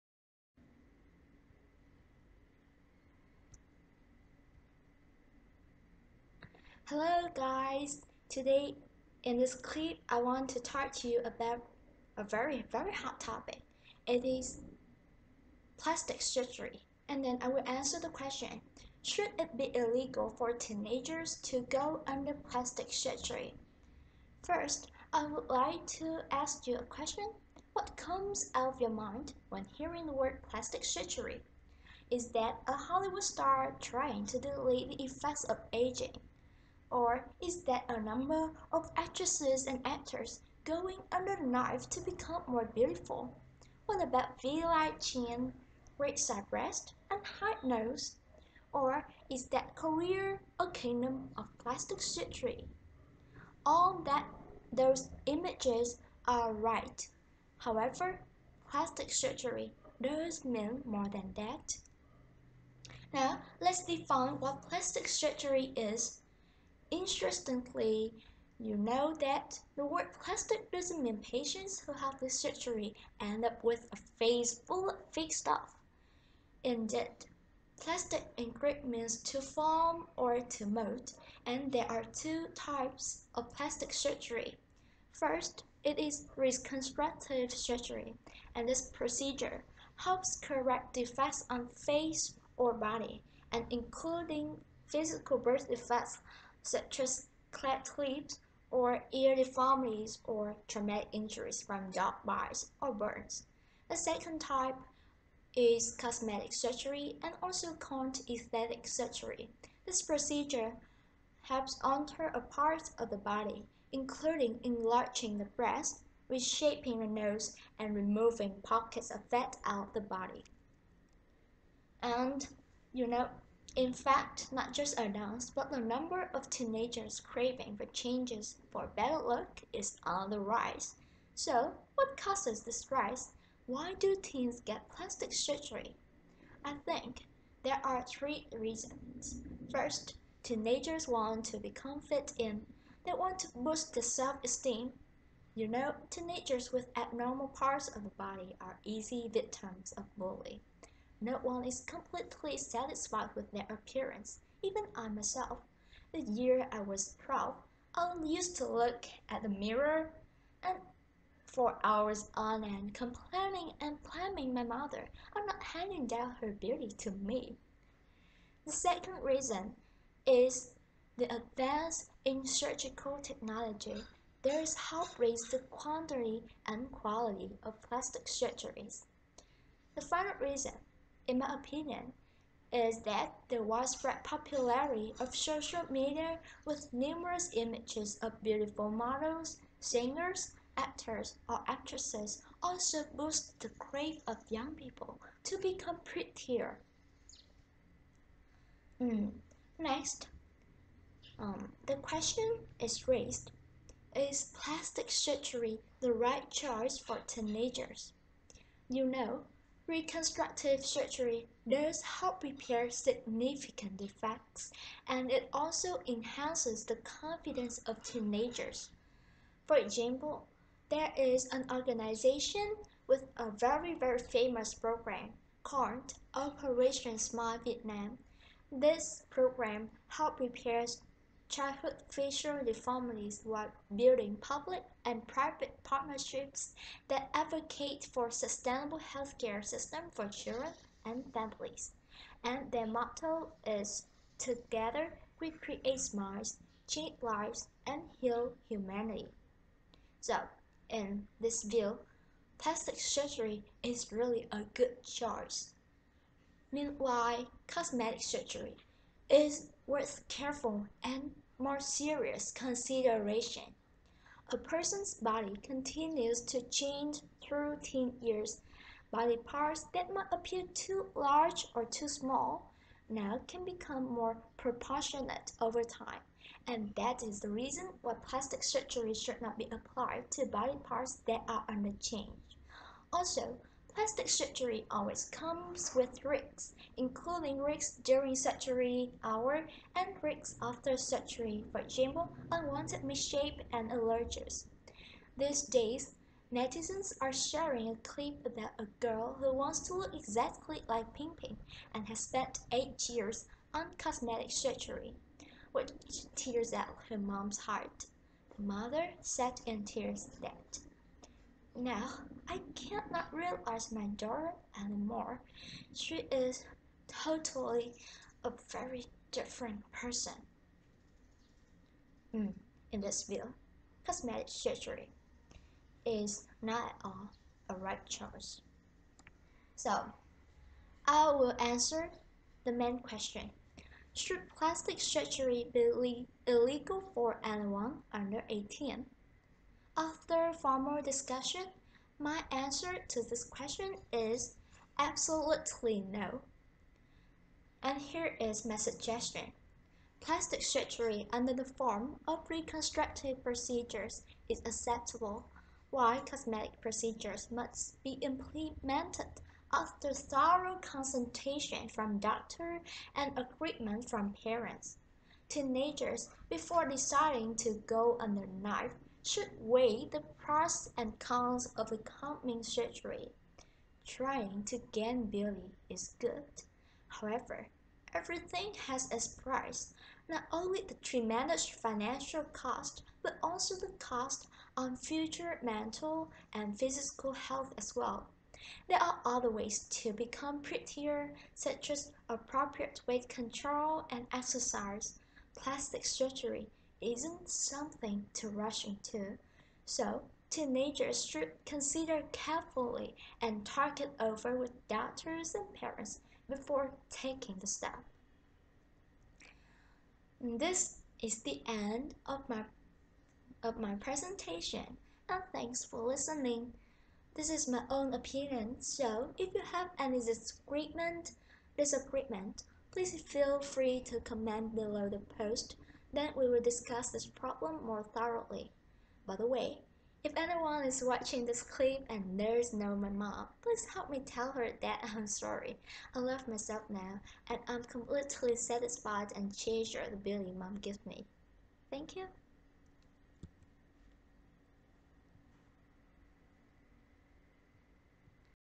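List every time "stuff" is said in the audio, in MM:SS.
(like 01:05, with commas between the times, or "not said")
01:15.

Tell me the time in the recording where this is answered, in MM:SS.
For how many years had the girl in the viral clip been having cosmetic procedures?
05:02.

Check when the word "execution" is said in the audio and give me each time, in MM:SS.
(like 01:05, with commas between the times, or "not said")
not said.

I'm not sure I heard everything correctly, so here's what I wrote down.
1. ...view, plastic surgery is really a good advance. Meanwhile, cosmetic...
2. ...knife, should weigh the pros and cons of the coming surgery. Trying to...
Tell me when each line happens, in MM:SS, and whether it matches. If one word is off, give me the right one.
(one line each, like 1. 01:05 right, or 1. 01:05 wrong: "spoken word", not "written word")
1. 04:11 wrong: "choice", not "advance"
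2. 06:08 right.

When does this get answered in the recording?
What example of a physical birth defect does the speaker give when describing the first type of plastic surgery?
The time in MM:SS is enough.
01:37.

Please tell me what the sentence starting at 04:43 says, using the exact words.
Also, Plastic surgery always comes with risks, including risks during surgery hour and risks after surgery, for example, unwanted misshape and allergies.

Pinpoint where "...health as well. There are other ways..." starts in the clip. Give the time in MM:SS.
06:27.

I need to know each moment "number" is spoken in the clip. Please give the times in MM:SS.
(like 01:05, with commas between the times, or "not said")
00:38, 02:05.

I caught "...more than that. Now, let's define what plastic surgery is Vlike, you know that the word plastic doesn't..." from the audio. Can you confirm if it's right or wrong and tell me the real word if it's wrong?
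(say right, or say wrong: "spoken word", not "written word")
wrong: "Interestingly", not "Vlike".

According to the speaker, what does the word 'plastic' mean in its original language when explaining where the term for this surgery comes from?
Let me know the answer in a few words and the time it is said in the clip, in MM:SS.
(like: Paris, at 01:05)
to form or to mold, at 01:19.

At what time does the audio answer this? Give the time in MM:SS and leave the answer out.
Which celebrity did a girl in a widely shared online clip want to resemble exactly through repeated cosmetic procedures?
05:01.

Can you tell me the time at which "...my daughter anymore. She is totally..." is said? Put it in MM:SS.
05:13.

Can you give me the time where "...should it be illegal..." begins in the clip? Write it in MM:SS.
00:19.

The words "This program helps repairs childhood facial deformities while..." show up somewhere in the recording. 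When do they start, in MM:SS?
03:48.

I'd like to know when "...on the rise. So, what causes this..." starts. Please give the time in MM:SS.
02:10.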